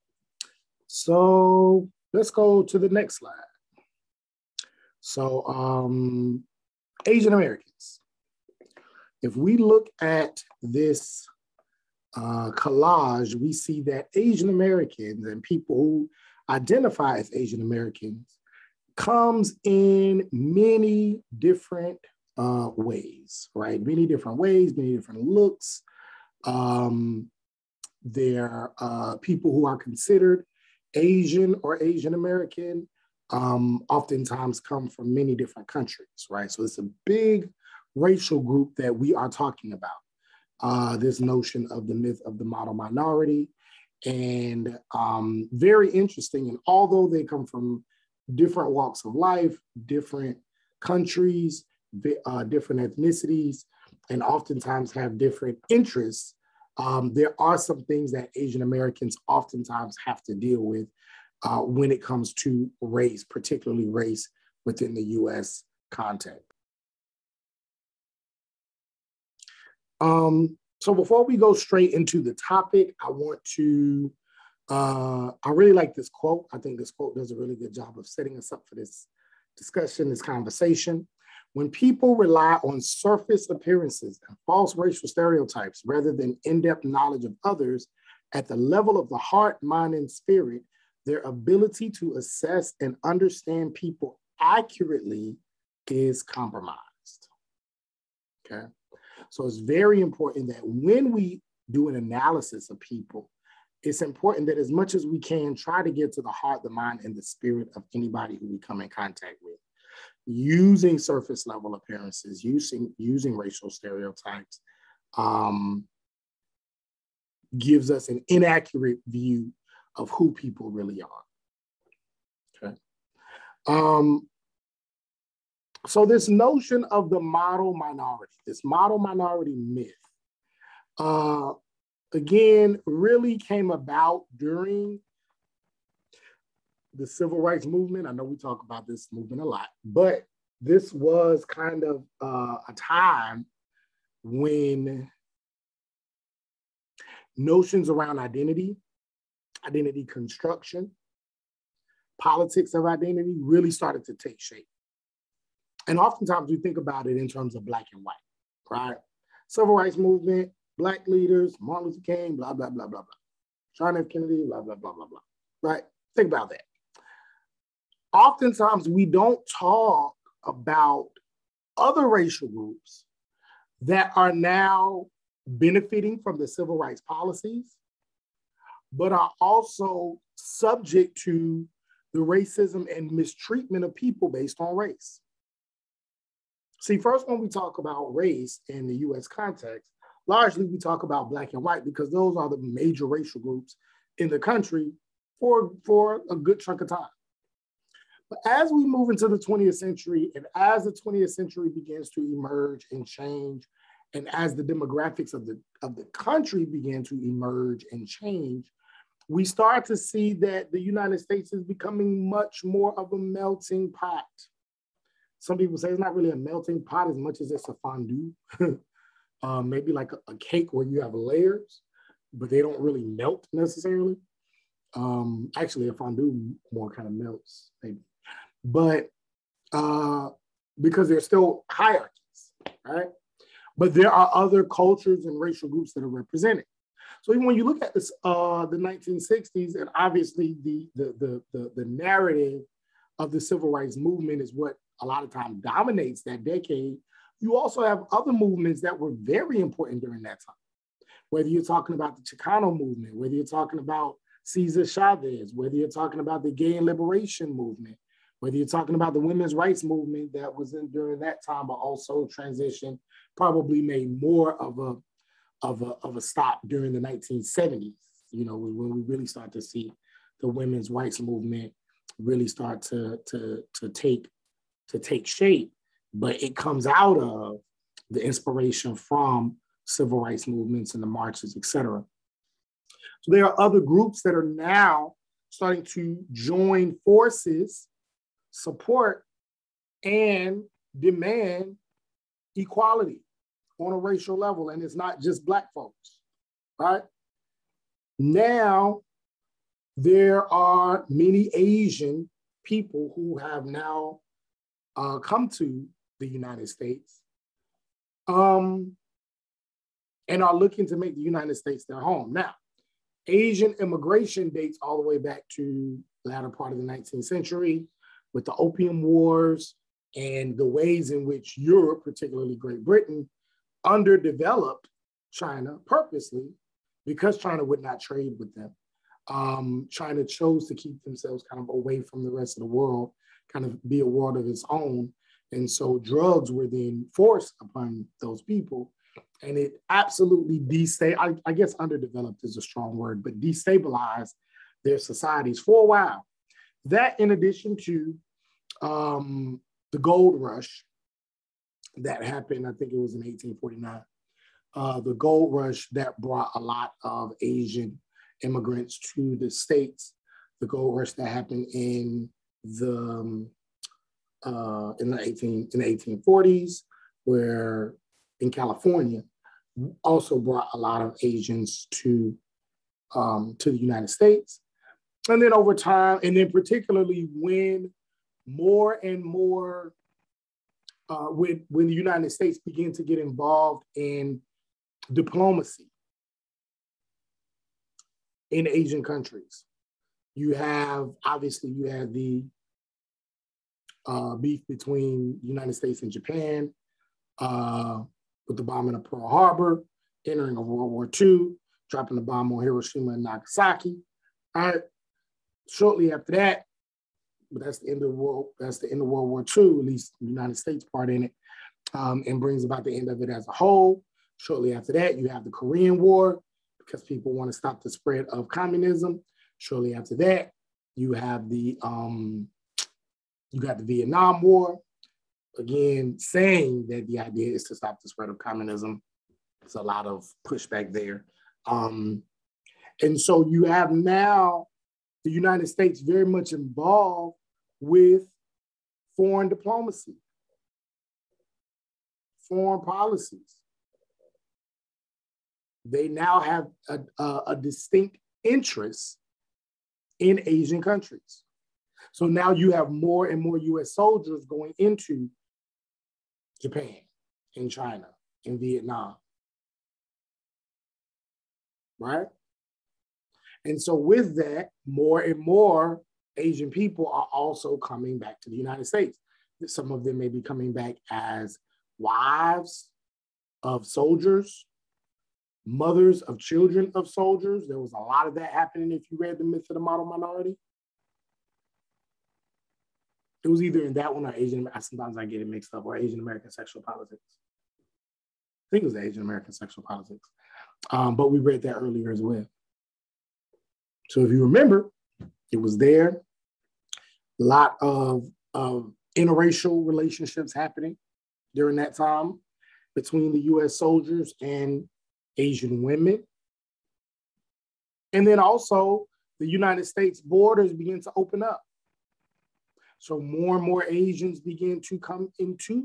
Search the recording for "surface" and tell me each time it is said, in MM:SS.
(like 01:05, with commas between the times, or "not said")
01:22, 01:50.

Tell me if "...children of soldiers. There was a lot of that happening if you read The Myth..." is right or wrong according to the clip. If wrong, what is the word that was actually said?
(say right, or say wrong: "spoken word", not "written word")
right.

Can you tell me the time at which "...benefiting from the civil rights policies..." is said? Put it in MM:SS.
02:55.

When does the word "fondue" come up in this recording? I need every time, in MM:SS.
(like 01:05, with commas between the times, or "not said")
03:37, 03:45.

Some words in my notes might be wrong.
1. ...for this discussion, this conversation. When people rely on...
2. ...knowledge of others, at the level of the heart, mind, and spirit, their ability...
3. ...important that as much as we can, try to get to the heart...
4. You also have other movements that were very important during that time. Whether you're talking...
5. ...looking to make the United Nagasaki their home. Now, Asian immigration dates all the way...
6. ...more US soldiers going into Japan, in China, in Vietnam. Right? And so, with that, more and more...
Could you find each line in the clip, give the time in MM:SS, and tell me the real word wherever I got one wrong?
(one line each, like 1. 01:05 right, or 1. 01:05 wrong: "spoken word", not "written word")
1. 01:18 right
2. 01:26 right
3. 01:44 right
4. 04:07 right
5. 05:10 wrong: "States", not "Nagasaki"
6. 07:33 right.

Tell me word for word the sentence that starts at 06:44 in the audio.
All right shortly after that, but that's the end of world.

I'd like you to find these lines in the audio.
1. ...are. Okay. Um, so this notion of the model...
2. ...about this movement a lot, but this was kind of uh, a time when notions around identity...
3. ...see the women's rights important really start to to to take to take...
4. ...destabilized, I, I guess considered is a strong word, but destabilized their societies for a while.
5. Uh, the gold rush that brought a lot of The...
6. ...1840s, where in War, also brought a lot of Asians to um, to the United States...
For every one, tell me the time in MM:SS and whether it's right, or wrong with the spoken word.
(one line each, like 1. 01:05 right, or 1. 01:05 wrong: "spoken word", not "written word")
1. 02:01 right
2. 02:18 right
3. 04:29 wrong: "movement", not "important"
4. 05:40 wrong: "underdeveloped", not "considered"
5. 05:54 wrong: "Asian", not "The"
6. 06:05 wrong: "California", not "War".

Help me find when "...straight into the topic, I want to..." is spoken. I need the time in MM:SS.
01:11.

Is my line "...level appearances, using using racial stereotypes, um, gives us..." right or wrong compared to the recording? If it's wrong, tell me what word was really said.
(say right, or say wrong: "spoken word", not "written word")
right.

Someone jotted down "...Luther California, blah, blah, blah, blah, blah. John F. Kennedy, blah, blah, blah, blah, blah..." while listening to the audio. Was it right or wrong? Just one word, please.
wrong.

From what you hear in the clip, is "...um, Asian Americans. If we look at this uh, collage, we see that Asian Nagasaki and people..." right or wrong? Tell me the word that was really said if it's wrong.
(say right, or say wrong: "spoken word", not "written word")
wrong: "Americans", not "Nagasaki".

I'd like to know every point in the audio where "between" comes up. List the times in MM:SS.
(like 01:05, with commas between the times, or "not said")
06:34, 08:22.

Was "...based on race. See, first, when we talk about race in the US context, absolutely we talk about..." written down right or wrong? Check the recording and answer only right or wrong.
wrong.